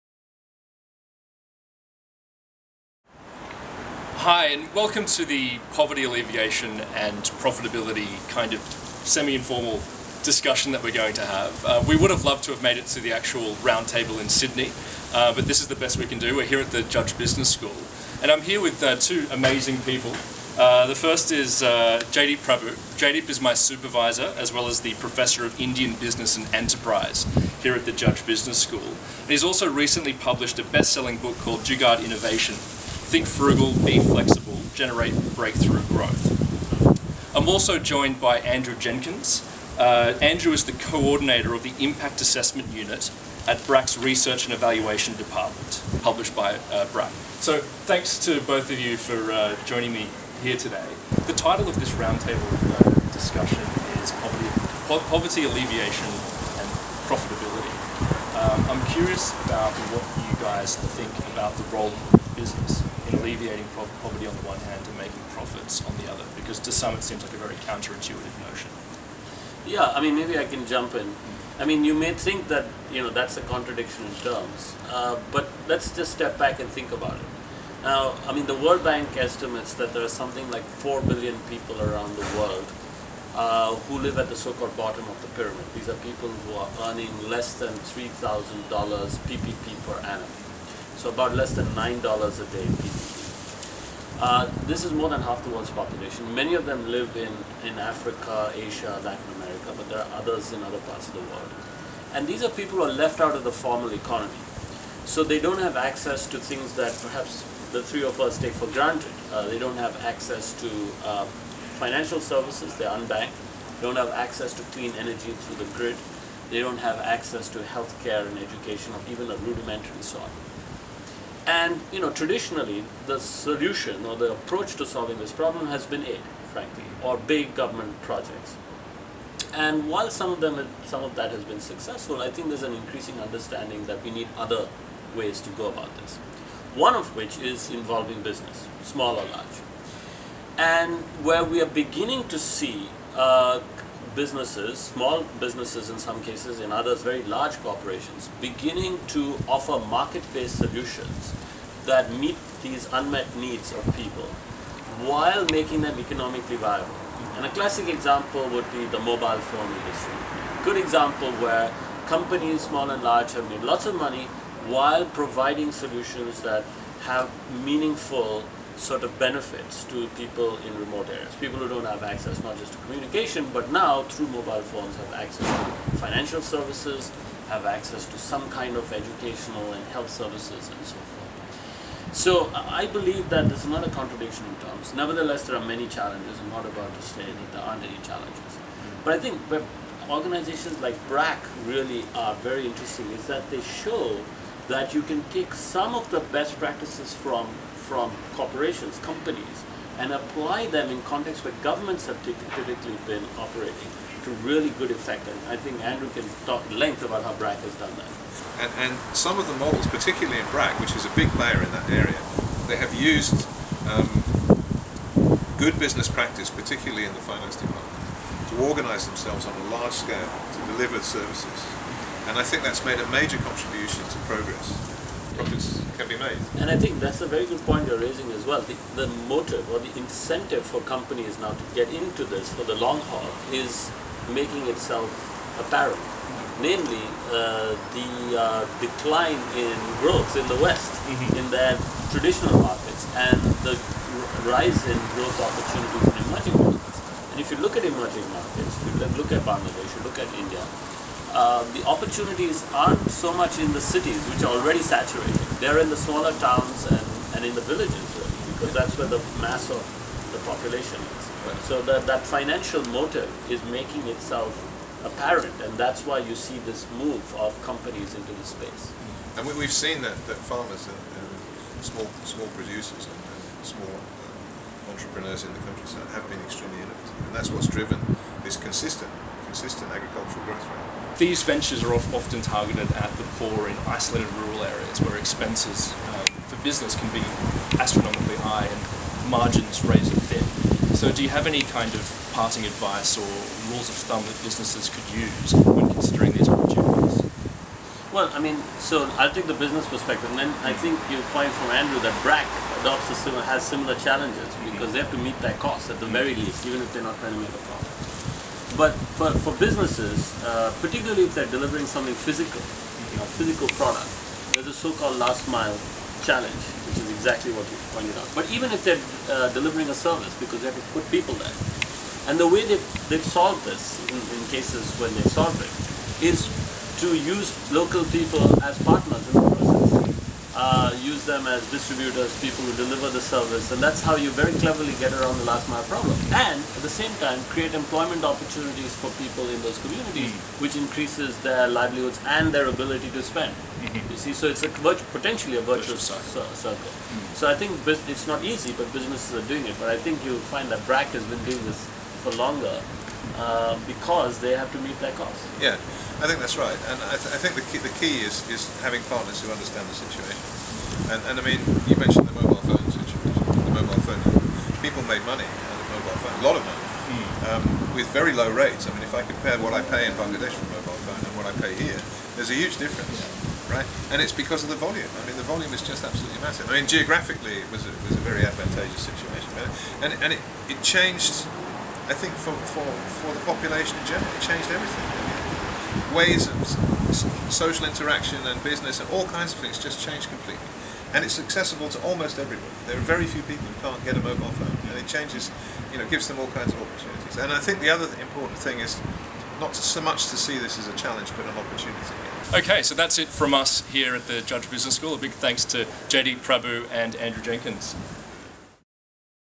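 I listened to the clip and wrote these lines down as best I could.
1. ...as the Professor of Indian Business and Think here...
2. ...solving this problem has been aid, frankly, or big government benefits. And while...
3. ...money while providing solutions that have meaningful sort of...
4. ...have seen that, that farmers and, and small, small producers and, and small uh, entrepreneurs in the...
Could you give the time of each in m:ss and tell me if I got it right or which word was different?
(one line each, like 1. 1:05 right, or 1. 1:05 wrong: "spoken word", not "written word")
1. 0:24 wrong: "Enterprise", not "Think"
2. 2:04 wrong: "projects", not "benefits"
3. 2:43 right
4. 4:29 right.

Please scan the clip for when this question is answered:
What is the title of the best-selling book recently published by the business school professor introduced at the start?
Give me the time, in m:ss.
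0:31.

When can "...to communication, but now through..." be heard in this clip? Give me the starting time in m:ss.
2:52.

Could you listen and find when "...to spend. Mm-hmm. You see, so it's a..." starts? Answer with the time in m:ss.
5:43.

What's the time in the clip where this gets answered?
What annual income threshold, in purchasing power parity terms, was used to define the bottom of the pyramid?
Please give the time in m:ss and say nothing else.
1:27.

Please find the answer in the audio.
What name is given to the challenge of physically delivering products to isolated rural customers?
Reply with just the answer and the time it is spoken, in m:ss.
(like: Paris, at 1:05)
last mile challenge, at 5:15.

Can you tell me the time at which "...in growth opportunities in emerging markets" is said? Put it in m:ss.
4:04.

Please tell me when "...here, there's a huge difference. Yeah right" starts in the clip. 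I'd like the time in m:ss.
6:11.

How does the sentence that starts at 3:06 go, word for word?
I'm not about to say that there aren't any challenges.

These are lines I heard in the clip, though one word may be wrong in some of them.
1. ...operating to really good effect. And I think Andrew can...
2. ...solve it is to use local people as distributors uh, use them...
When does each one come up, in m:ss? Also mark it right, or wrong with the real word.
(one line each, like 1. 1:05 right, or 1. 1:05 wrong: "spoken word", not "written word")
1. 3:23 right
2. 5:25 wrong: "partners", not "distributors".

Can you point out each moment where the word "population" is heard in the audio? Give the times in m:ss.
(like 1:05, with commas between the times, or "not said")
1:35, 4:20, 6:23.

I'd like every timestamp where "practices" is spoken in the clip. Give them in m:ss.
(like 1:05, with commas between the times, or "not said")
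3:16, 3:36.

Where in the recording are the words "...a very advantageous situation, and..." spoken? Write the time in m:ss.
6:18.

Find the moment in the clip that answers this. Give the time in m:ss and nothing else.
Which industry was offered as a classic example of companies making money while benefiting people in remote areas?
2:38.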